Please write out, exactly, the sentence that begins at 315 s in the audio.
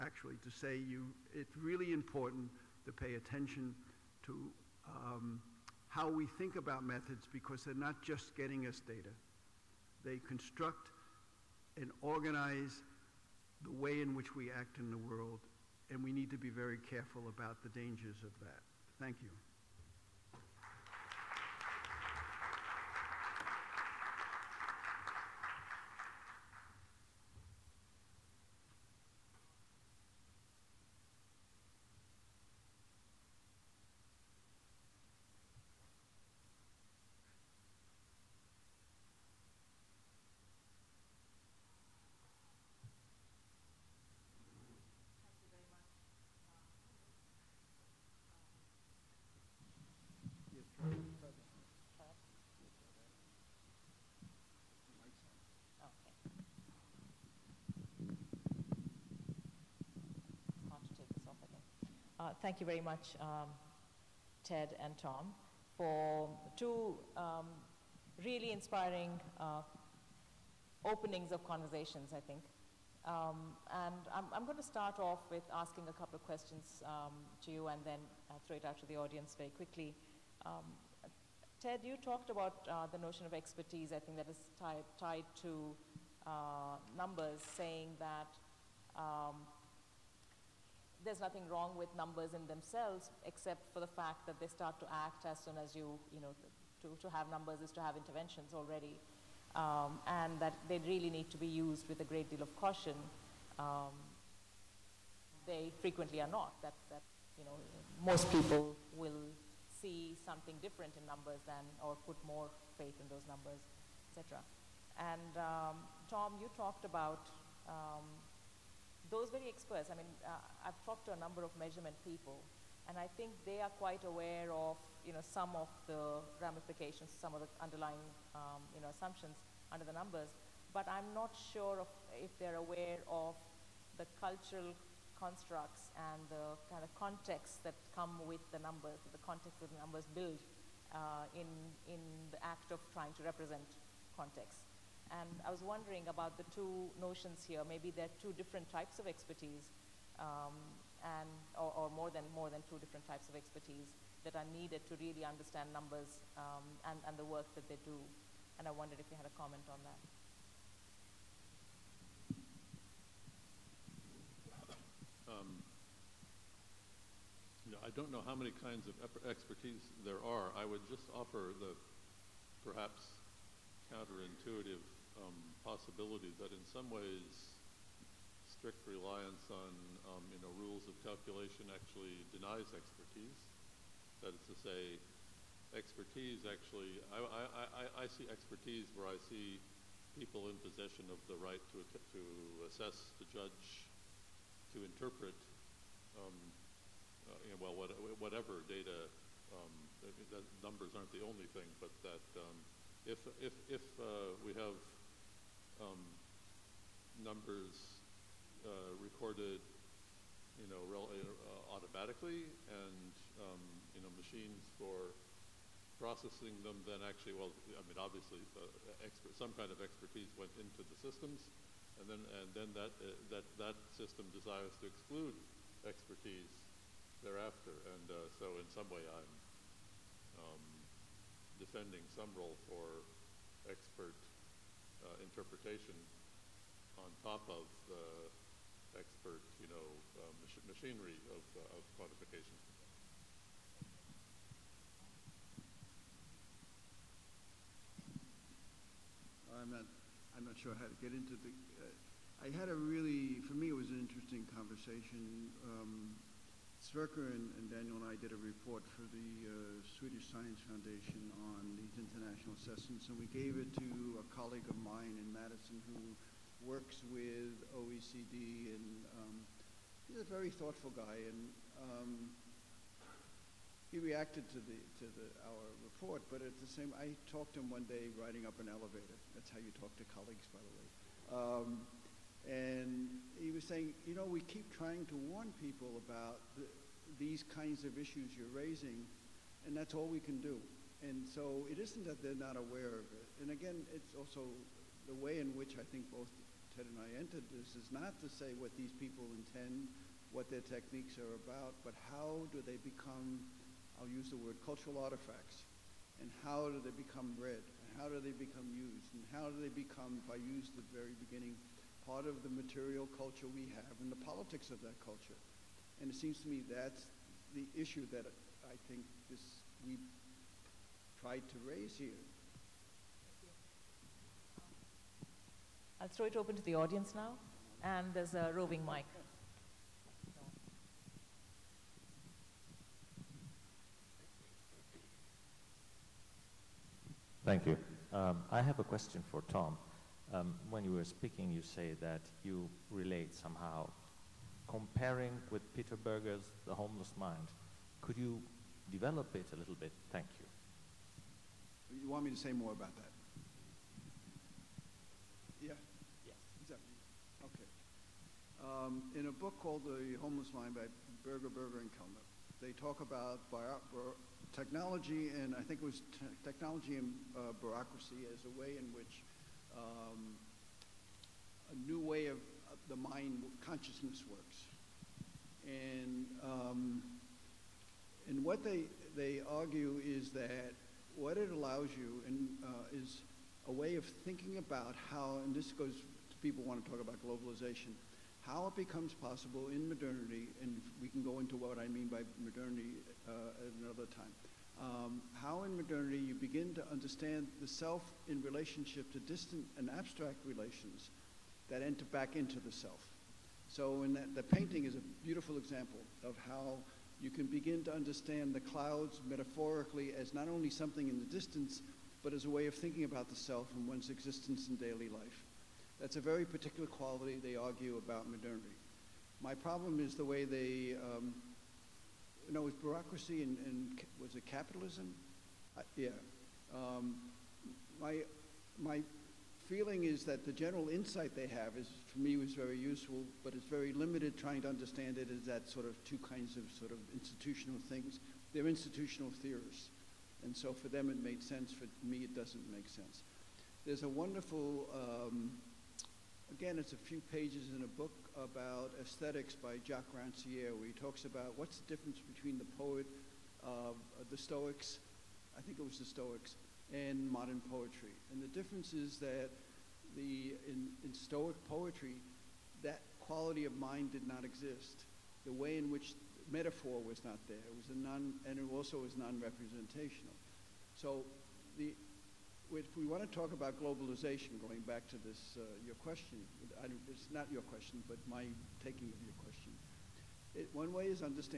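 And it seems to me that's the issue that I think this we tried to raise here.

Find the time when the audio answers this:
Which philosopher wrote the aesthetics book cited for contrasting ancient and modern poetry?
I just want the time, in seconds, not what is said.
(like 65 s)
449 s.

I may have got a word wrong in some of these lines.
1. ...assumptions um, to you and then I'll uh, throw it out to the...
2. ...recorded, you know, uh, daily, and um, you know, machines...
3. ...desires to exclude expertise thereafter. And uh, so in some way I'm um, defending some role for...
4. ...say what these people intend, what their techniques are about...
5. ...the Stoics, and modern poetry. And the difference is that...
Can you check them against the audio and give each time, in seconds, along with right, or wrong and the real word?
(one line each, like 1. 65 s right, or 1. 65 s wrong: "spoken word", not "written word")
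1. 76 s wrong: "questions", not "assumptions"
2. 208 s wrong: "automatically", not "daily"
3. 224 s right
4. 298 s right
5. 455 s right.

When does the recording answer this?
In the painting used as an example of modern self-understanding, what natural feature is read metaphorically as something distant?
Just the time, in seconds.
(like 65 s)
408 s.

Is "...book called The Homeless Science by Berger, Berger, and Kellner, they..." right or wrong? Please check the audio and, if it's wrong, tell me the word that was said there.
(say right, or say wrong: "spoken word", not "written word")
wrong: "Mind", not "Science".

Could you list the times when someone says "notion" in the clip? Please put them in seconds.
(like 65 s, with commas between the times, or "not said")
82 s, 146 s.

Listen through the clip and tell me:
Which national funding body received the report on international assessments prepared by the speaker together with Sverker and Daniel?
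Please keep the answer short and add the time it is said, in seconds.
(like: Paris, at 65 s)
Swedish Science Foundation, at 259 s.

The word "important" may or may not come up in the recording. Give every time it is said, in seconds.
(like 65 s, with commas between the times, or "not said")
1 s.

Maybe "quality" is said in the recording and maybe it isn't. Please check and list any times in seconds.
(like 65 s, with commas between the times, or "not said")
416 s, 463 s.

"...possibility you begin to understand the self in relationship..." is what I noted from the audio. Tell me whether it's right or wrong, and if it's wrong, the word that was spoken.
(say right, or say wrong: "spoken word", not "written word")
wrong: "modernity", not "possibility".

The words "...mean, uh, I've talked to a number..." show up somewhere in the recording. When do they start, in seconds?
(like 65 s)
119 s.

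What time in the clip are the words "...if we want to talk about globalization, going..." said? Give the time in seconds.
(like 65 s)
472 s.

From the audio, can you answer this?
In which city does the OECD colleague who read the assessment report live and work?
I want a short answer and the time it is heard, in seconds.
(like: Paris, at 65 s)
Madison, at 265 s.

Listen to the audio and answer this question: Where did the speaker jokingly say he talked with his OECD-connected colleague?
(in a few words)
An elevator.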